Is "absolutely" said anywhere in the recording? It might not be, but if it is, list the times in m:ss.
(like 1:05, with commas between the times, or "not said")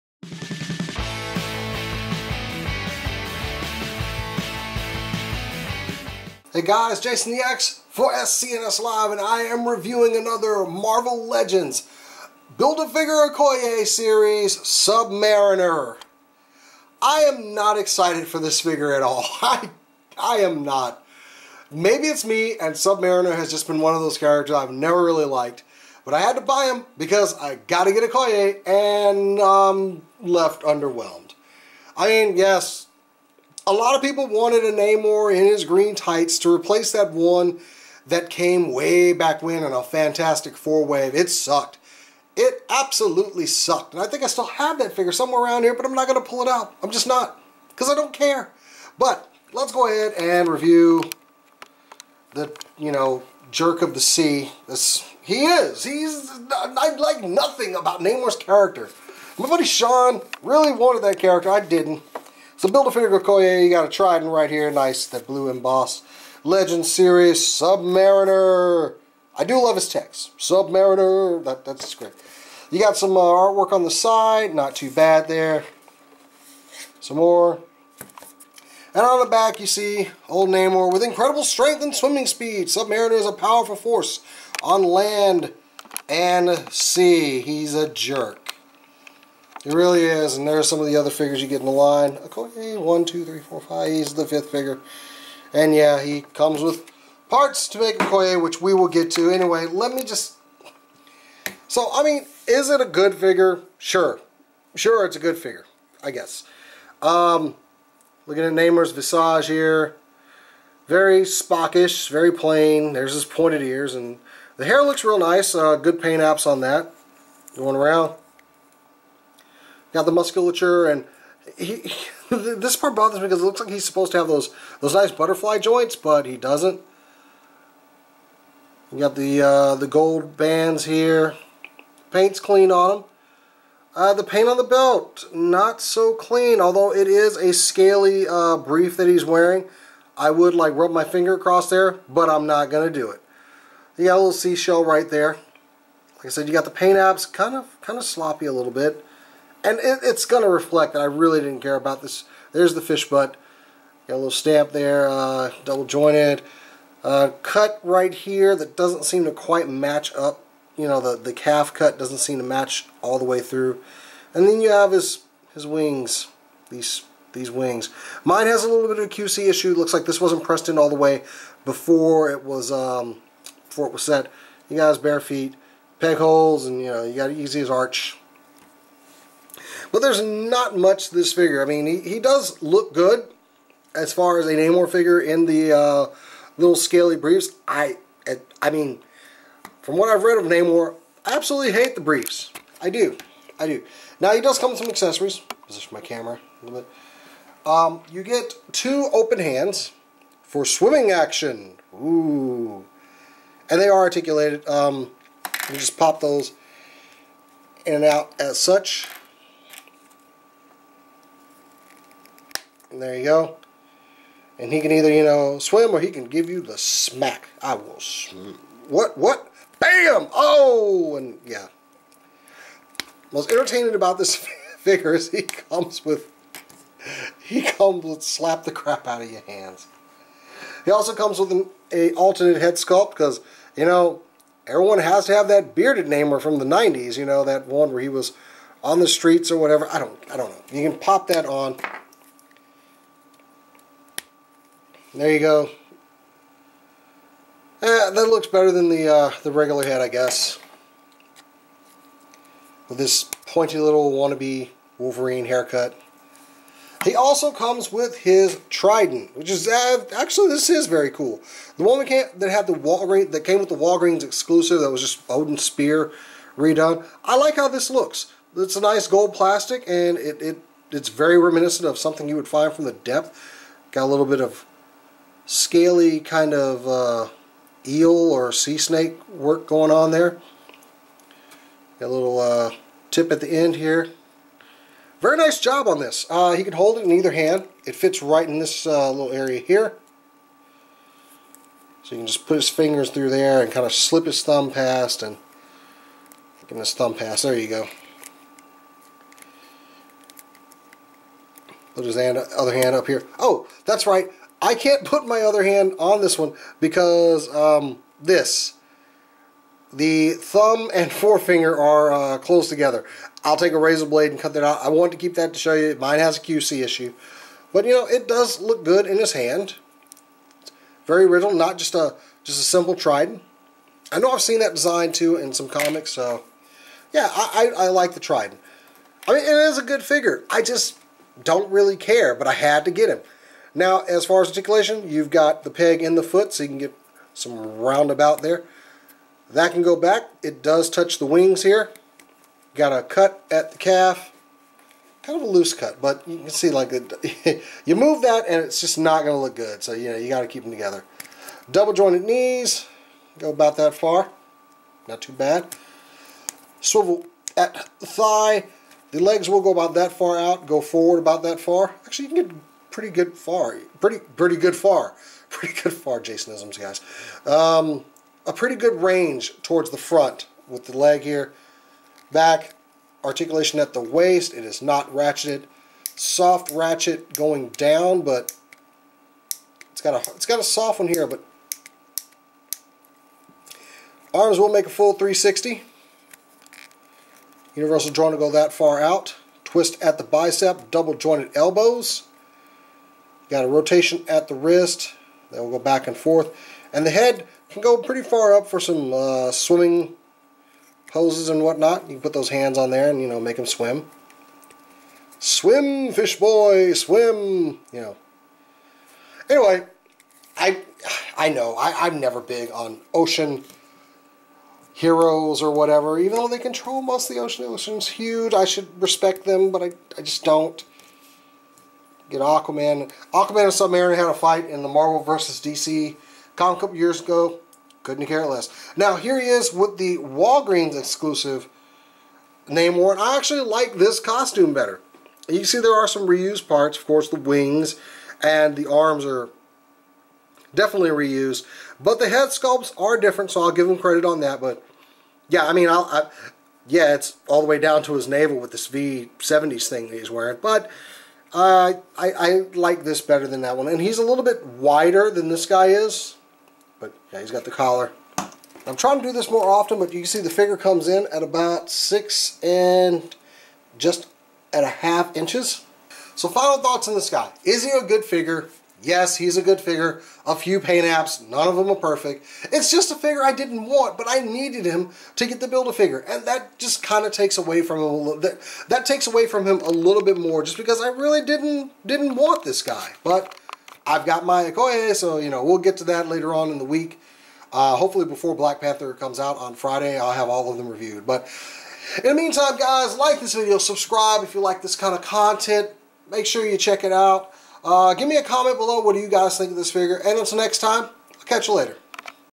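0:42, 3:11.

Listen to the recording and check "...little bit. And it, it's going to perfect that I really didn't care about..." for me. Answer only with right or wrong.
wrong.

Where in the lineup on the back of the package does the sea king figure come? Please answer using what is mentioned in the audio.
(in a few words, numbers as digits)
fifth.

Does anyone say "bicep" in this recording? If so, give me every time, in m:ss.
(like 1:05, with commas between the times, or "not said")
6:30.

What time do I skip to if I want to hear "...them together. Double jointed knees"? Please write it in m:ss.
5:50.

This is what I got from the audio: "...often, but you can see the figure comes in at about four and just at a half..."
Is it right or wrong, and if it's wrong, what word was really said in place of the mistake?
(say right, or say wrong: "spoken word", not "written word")
wrong: "six", not "four".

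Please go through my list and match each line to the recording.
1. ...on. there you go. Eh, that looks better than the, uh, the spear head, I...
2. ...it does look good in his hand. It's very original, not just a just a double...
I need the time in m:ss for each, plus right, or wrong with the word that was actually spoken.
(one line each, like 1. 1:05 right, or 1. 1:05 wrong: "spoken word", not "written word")
1. 4:01 wrong: "regular", not "spear"
2. 5:18 wrong: "simple", not "double".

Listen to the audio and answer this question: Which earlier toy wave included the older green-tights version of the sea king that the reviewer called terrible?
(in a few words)
Fantastic Four.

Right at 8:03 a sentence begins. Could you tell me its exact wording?
But I've got my Okoye, so you know, we'll get to that later on in the week.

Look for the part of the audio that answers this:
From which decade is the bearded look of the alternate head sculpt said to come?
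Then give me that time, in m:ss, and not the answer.
3:56.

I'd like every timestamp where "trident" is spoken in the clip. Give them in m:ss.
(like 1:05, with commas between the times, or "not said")
1:03, 4:18, 5:22, 5:28.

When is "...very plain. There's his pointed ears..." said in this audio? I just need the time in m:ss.
1:52.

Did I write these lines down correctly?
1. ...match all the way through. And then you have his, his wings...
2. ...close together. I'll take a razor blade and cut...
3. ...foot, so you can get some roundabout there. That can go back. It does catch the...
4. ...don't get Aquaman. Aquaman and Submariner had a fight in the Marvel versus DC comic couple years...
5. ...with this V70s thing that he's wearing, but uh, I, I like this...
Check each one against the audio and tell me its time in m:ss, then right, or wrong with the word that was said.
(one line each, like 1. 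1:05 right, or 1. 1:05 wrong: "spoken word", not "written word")
1. 2:42 right
2. 5:12 right
3. 5:36 wrong: "touch", not "catch"
4. 7:00 right
5. 7:28 right.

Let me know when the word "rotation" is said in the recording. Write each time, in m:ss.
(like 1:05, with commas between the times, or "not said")
6:33.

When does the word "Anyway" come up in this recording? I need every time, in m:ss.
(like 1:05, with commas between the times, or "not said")
1:39, 6:49.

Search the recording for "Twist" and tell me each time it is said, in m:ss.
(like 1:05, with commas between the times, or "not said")
6:29.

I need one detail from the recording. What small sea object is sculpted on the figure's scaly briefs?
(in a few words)
seashell.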